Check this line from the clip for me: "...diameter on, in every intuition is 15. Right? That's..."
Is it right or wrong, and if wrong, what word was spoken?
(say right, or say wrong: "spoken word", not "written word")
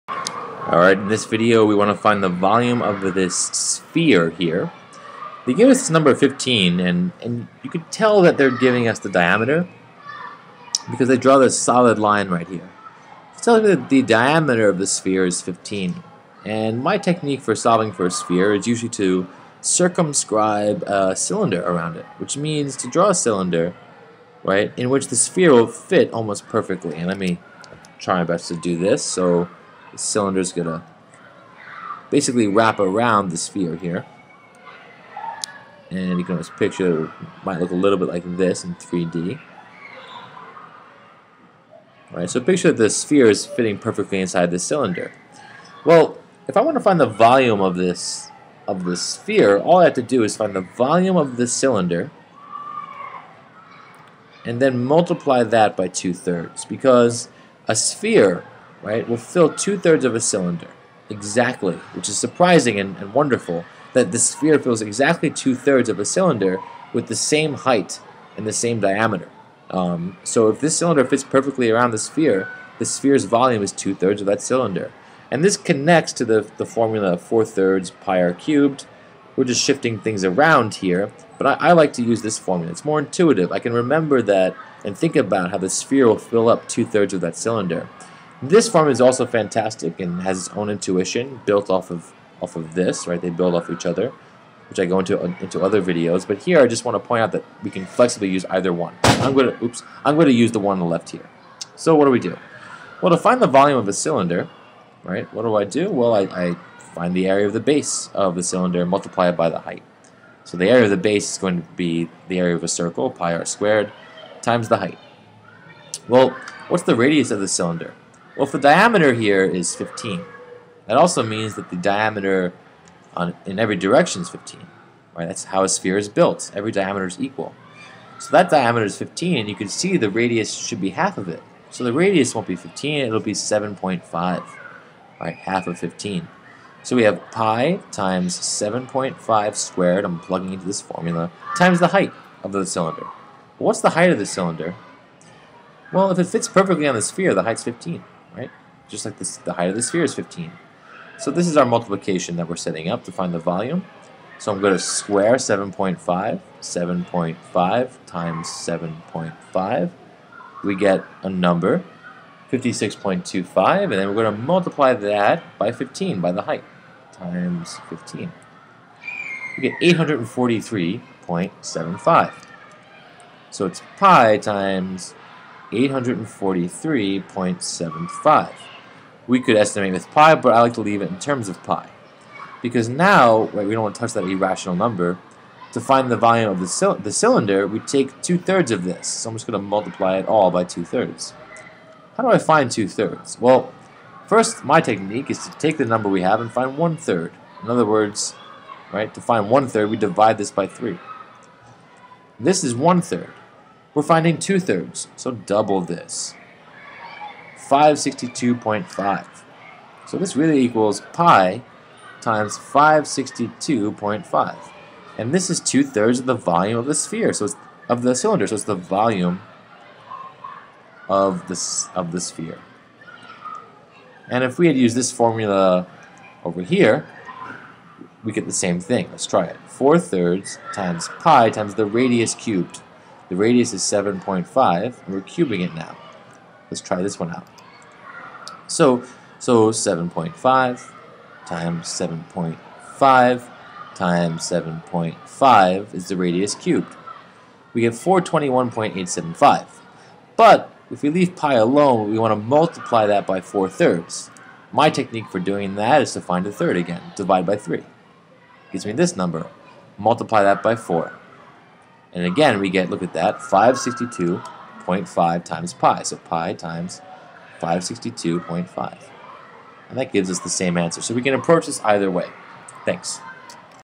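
wrong: "direction", not "intuition".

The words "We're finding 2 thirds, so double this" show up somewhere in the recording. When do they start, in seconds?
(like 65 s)
203 s.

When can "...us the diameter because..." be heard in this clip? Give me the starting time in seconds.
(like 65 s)
8 s.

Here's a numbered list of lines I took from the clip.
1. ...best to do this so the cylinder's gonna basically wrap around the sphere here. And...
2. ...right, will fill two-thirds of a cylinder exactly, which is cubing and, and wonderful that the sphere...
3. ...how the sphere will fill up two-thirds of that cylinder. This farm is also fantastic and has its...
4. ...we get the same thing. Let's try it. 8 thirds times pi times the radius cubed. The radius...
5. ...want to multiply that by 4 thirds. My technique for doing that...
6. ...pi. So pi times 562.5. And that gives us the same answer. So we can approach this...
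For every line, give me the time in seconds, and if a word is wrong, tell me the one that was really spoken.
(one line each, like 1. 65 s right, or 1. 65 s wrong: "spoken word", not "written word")
1. 28 s right
2. 58 s wrong: "surprising", not "cubing"
3. 85 s right
4. 228 s wrong: "4", not "8"
5. 252 s right
6. 265 s right.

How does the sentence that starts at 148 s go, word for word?
Just like this, the height of the sphere is 15.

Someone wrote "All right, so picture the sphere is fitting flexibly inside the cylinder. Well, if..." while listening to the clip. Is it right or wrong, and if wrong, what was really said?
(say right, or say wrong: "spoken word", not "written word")
wrong: "perfectly", not "flexibly".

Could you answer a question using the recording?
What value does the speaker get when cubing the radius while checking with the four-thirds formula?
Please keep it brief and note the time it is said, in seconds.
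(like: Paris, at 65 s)
421.875, at 247 s.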